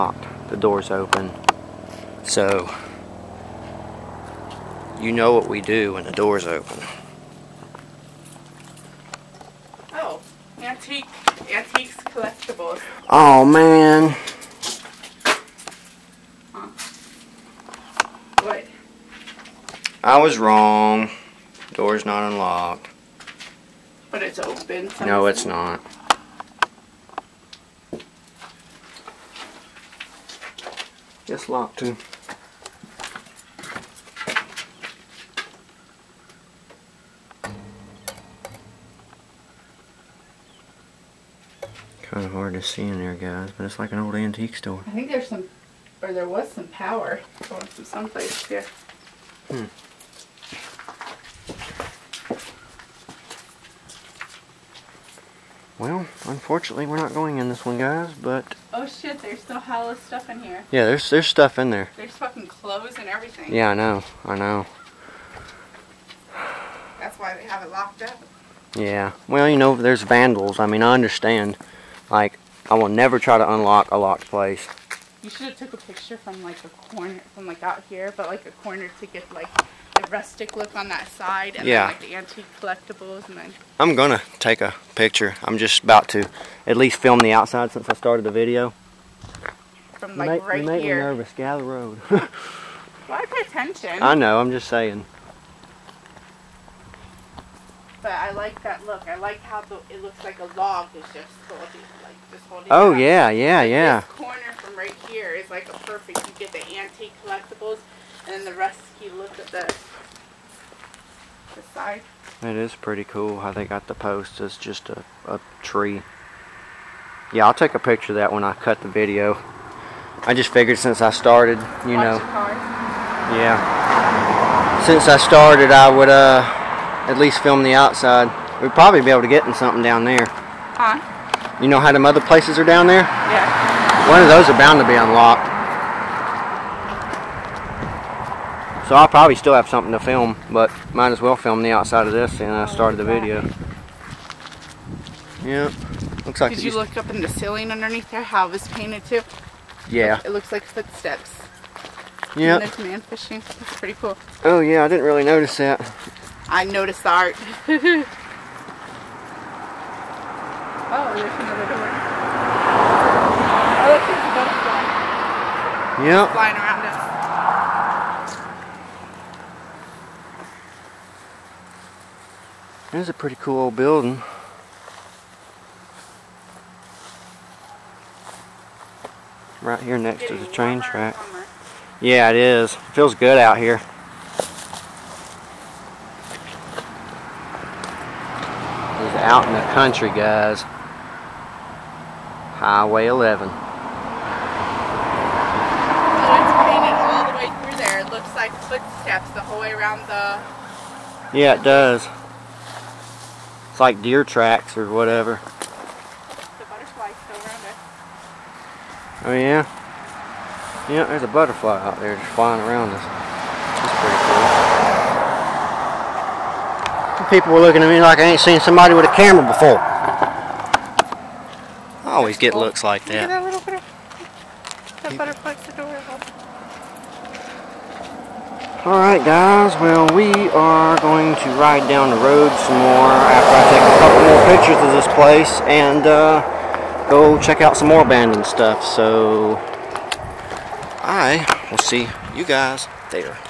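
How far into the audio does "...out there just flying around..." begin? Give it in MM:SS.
03:31.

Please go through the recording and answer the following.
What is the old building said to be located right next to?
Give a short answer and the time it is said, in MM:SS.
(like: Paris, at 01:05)
The train track, at 03:00.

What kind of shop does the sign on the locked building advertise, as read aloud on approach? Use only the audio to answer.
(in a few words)
Antiques collectibles.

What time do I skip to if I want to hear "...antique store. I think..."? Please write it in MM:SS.
00:44.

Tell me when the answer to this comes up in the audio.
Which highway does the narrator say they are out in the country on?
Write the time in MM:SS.
03:12.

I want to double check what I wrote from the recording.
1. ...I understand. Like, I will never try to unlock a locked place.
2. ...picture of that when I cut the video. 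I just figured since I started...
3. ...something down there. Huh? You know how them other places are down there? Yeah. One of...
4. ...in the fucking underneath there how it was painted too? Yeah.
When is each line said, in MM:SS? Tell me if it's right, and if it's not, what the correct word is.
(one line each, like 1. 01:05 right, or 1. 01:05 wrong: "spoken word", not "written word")
1. 01:10 right
2. 01:57 right
3. 02:09 right
4. 02:27 wrong: "ceiling", not "fucking".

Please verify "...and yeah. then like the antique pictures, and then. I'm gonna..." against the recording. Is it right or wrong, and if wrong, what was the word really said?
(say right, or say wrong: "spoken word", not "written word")
wrong: "collectibles", not "pictures".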